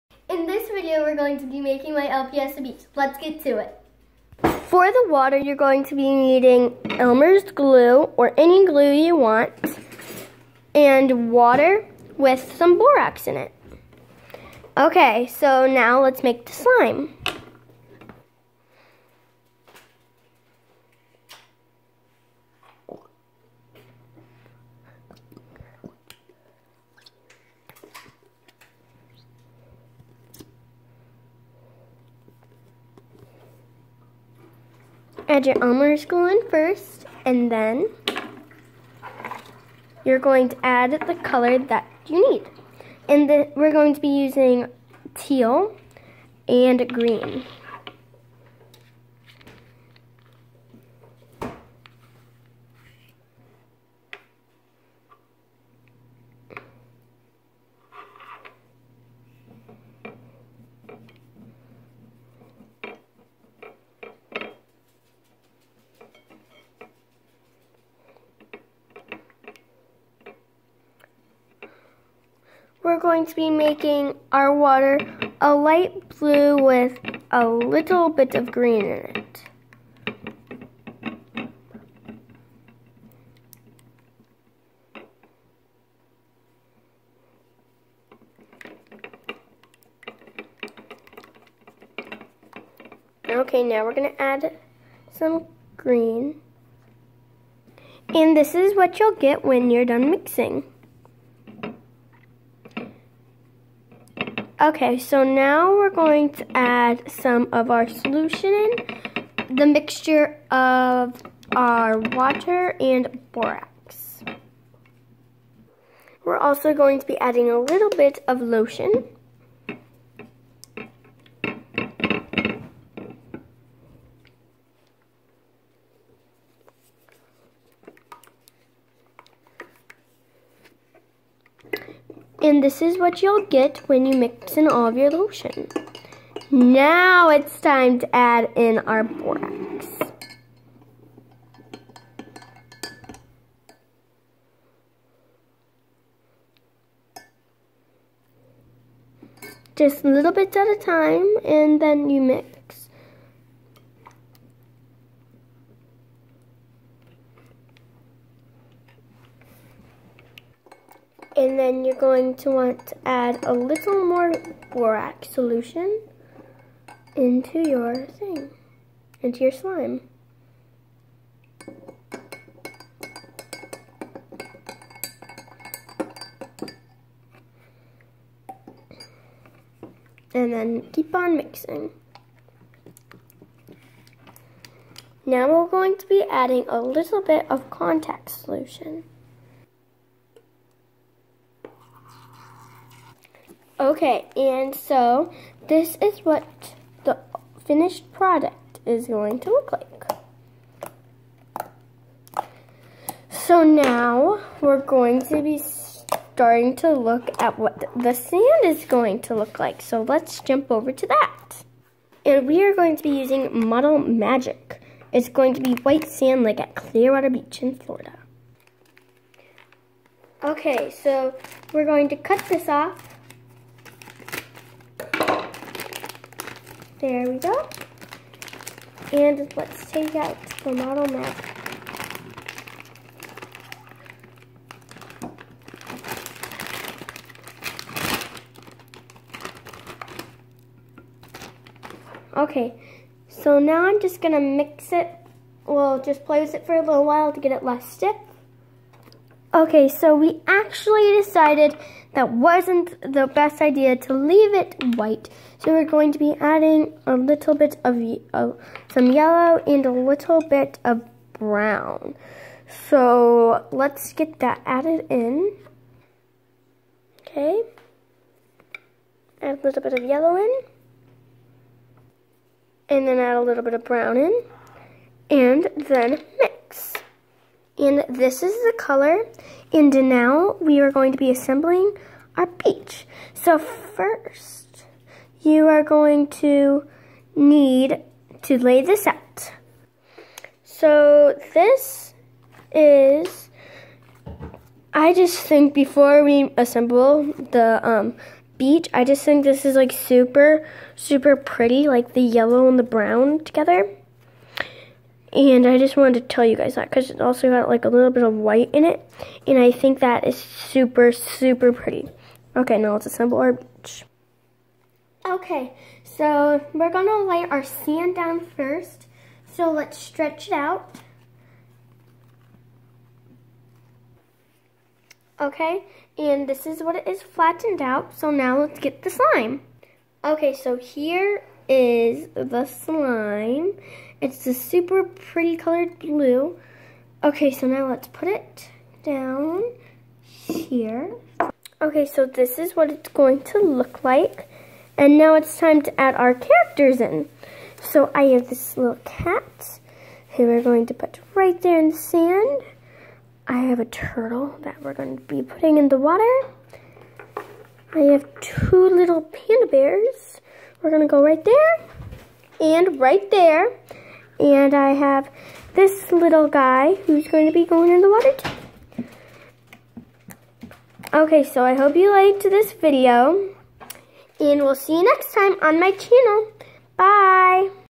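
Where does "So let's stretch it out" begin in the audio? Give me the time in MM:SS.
05:19.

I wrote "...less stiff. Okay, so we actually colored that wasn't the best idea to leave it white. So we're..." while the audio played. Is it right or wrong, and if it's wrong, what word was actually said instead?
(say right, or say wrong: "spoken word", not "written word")
wrong: "decided", not "colored".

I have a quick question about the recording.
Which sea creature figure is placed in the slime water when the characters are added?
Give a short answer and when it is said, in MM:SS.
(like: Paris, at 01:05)
A turtle, at 05:53.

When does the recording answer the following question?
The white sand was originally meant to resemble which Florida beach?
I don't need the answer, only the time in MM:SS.
03:36.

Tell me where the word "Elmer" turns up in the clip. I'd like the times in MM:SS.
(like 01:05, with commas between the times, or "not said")
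00:06, 00:35.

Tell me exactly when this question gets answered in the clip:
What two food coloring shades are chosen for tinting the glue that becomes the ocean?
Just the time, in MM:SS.
00:45.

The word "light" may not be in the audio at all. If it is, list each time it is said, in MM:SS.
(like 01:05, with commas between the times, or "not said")
01:15.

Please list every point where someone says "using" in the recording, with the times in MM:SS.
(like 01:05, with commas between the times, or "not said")
00:44, 03:33.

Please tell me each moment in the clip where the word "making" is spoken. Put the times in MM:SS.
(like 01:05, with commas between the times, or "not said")
00:01, 01:13.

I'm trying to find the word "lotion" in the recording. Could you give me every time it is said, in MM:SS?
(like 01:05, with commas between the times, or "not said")
01:58, 02:15.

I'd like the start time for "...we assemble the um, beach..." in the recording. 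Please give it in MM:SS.
04:56.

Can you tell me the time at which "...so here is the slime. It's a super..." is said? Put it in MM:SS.
05:30.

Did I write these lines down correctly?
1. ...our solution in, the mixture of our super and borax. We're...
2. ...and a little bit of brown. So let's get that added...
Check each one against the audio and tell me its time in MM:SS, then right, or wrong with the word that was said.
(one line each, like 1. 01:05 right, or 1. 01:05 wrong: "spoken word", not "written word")
1. 01:47 wrong: "water", not "super"
2. 04:19 right.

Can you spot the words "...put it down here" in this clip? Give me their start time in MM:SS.
05:38.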